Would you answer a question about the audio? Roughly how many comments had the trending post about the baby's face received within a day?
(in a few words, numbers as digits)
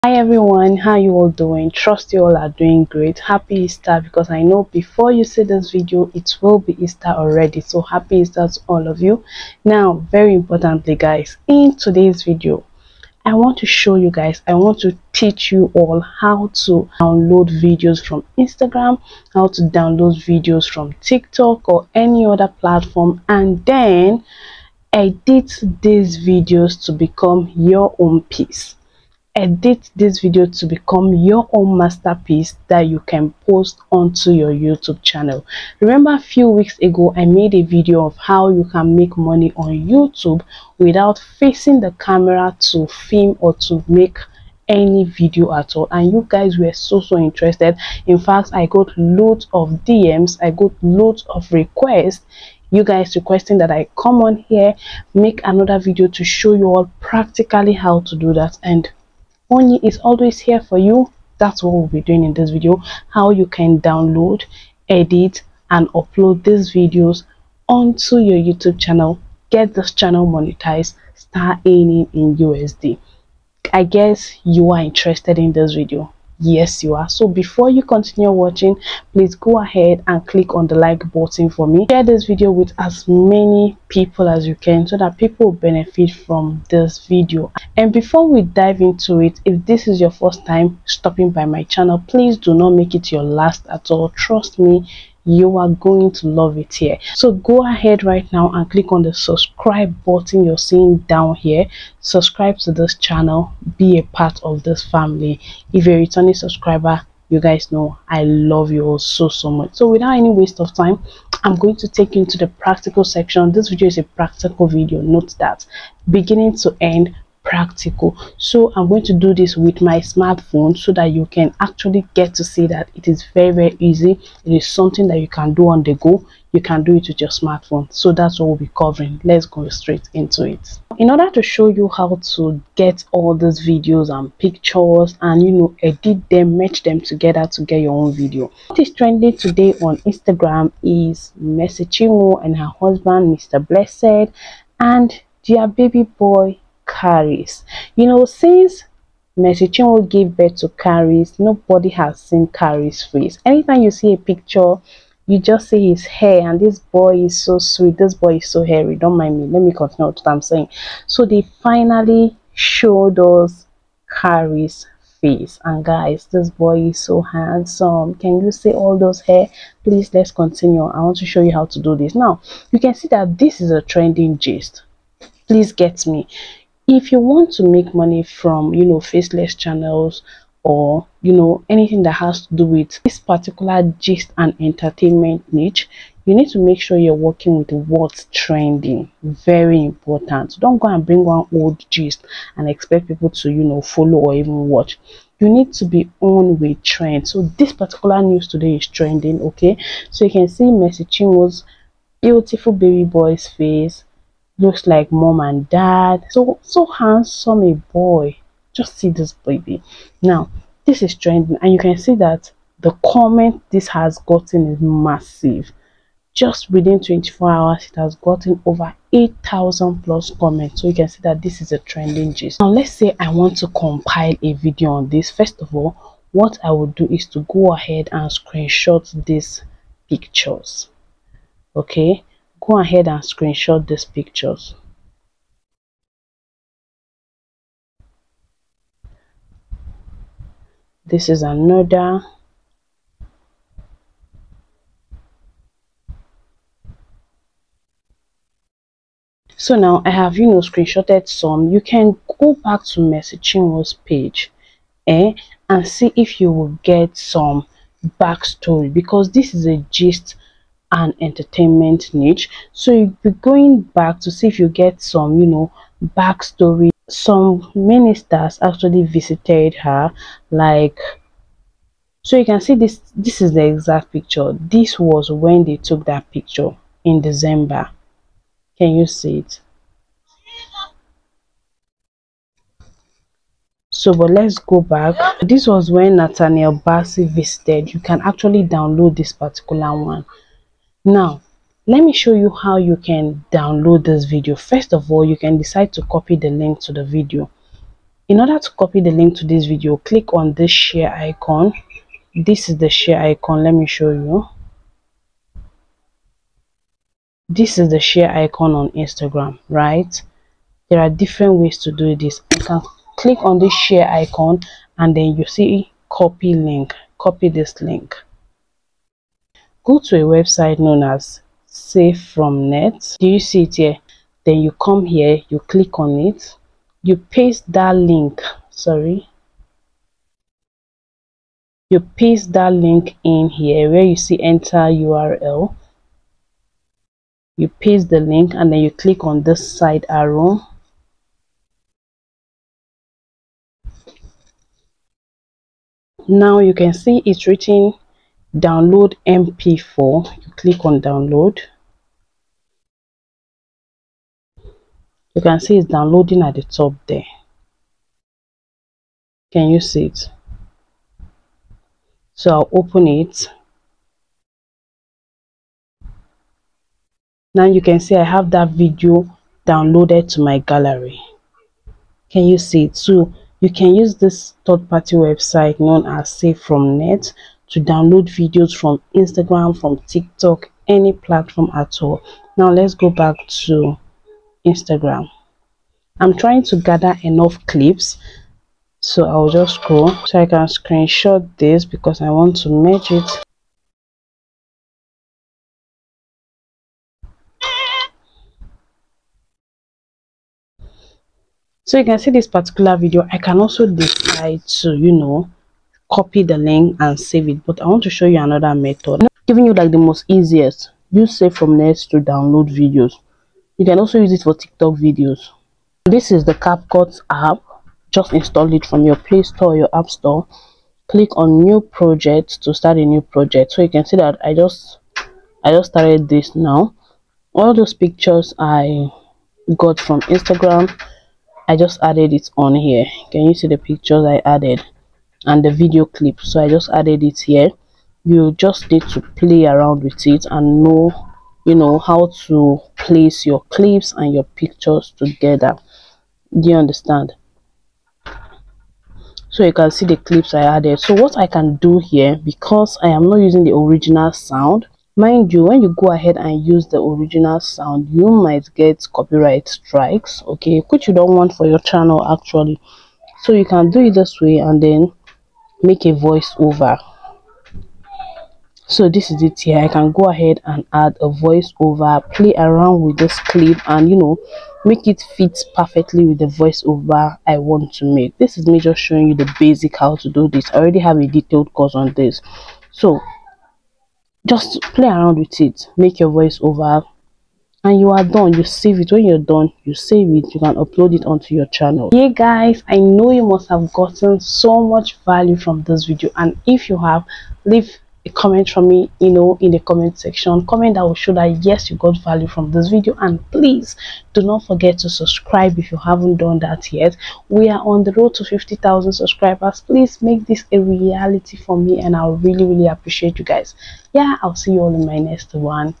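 8000.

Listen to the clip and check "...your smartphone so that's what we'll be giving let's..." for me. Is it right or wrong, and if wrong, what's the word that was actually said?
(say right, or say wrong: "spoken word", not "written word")
wrong: "covering", not "giving".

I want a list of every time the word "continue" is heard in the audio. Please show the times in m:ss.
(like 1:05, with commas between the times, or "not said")
1:17, 2:39, 2:50.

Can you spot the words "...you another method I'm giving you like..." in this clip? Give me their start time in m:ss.
6:48.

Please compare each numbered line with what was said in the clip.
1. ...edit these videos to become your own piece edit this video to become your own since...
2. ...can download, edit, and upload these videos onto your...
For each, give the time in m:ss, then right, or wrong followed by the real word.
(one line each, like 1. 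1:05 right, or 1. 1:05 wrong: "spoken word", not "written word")
1. 0:24 wrong: "masterpiece", not "since"
2. 1:03 right.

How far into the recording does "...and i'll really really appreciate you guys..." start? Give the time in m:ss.
8:31.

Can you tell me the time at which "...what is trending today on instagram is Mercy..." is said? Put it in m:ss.
2:18.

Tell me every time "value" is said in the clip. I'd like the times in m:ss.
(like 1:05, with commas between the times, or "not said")
8:15, 8:22.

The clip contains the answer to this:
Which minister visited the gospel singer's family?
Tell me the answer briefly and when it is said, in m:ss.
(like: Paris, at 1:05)
Nathaniel Bassey, at 4:46.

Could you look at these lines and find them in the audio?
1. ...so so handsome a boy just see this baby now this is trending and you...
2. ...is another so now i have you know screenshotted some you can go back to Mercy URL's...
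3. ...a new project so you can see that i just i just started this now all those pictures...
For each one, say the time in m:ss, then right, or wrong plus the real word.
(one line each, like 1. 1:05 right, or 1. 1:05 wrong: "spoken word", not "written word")
1. 3:26 right
2. 4:01 wrong: "Chinwo", not "URL"
3. 7:02 right.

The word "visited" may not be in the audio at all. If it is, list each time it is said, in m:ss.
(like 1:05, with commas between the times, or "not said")
4:29, 4:47.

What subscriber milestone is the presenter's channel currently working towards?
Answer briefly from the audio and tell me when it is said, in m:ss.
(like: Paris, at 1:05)
50,000, at 8:28.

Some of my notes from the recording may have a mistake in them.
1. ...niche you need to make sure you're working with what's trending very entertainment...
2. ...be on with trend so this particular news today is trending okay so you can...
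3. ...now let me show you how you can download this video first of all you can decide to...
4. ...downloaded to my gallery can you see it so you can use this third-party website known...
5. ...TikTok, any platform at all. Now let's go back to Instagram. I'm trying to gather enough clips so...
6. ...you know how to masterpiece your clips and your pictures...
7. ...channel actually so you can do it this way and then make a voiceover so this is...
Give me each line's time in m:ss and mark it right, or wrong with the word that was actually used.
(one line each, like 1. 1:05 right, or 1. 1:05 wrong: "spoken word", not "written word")
1. 3:05 wrong: "important", not "entertainment"
2. 3:15 right
3. 4:51 right
4. 6:09 right
5. 6:20 right
6. 7:21 wrong: "place", not "masterpiece"
7. 7:41 right.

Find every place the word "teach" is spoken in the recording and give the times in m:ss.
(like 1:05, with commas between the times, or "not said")
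0:15.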